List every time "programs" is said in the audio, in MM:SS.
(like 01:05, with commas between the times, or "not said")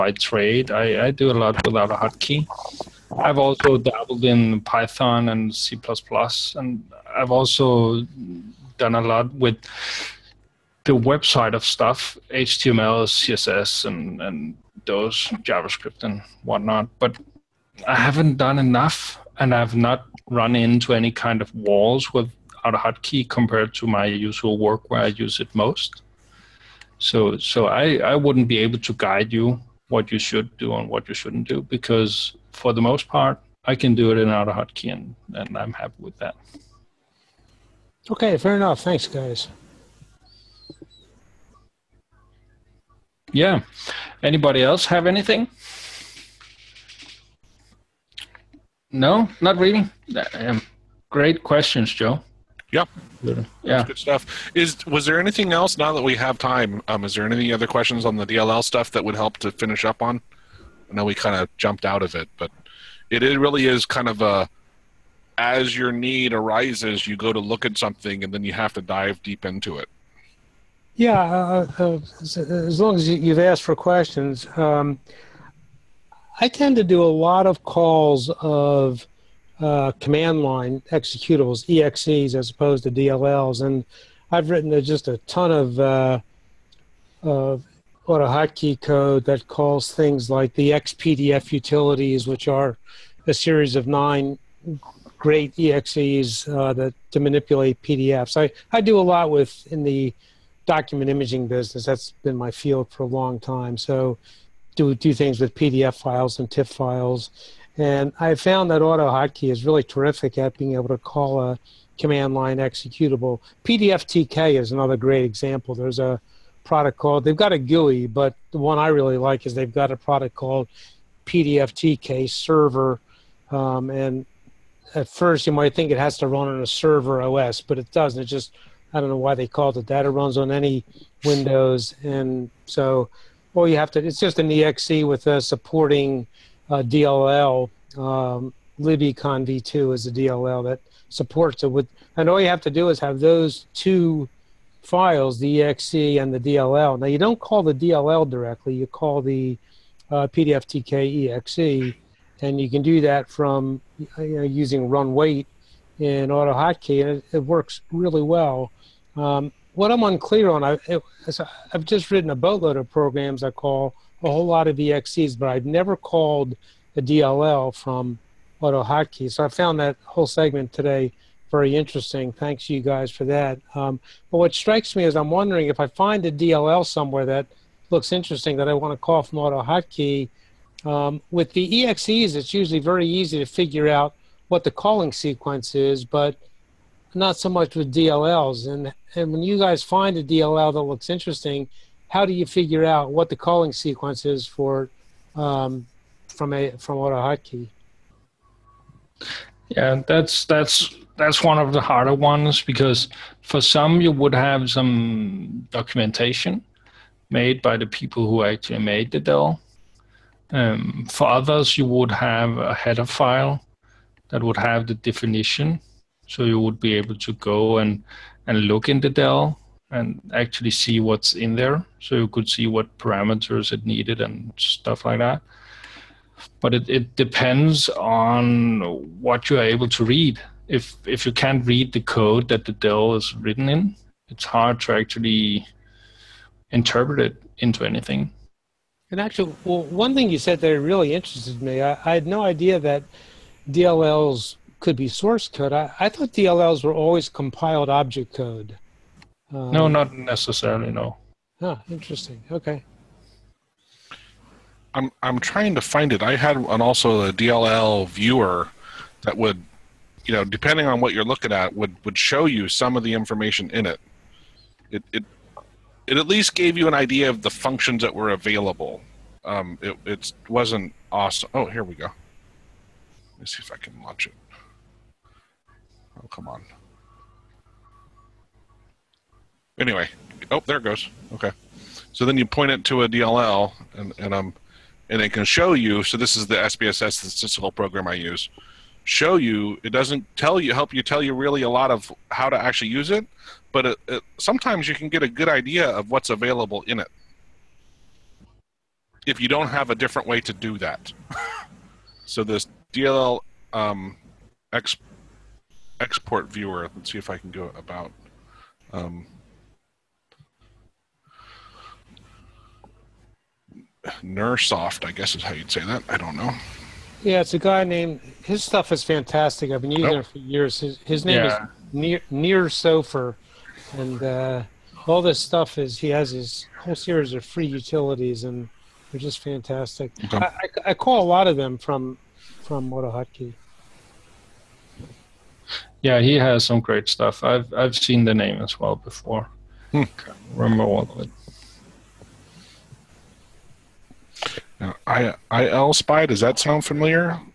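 02:42, 04:47.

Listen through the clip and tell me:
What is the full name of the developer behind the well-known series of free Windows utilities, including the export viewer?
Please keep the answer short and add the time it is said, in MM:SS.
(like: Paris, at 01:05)
Nir Sofer, at 05:22.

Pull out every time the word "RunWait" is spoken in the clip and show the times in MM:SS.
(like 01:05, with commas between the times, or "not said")
02:34.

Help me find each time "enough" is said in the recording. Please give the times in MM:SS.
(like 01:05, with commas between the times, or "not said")
00:18, 00:38.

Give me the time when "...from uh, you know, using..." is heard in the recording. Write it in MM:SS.
02:33.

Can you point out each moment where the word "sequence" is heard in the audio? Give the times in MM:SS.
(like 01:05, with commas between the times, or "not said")
03:05, 03:13.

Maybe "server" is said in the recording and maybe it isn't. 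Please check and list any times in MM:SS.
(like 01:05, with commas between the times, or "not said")
02:02, 02:06.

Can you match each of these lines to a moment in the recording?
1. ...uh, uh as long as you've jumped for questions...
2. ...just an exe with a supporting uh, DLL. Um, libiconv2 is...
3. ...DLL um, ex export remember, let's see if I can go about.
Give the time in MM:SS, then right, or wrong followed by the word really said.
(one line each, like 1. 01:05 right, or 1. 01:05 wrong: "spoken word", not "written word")
1. 01:11 wrong: "asked", not "jumped"
2. 02:14 right
3. 05:02 wrong: "viewer", not "remember".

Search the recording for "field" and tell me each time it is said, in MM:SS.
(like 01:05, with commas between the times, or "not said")
01:42.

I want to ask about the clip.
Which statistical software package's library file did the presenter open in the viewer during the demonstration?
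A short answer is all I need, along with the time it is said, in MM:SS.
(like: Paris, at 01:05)
SPSS, at 04:46.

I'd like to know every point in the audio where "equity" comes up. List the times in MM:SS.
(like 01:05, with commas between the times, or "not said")
not said.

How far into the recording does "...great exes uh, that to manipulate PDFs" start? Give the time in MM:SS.
01:35.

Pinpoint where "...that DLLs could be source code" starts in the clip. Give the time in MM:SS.
04:02.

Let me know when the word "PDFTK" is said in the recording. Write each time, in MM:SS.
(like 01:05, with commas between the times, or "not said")
01:53, 02:01, 02:30.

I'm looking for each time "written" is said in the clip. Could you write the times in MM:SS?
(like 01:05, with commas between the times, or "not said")
01:24, 02:42, 03:53.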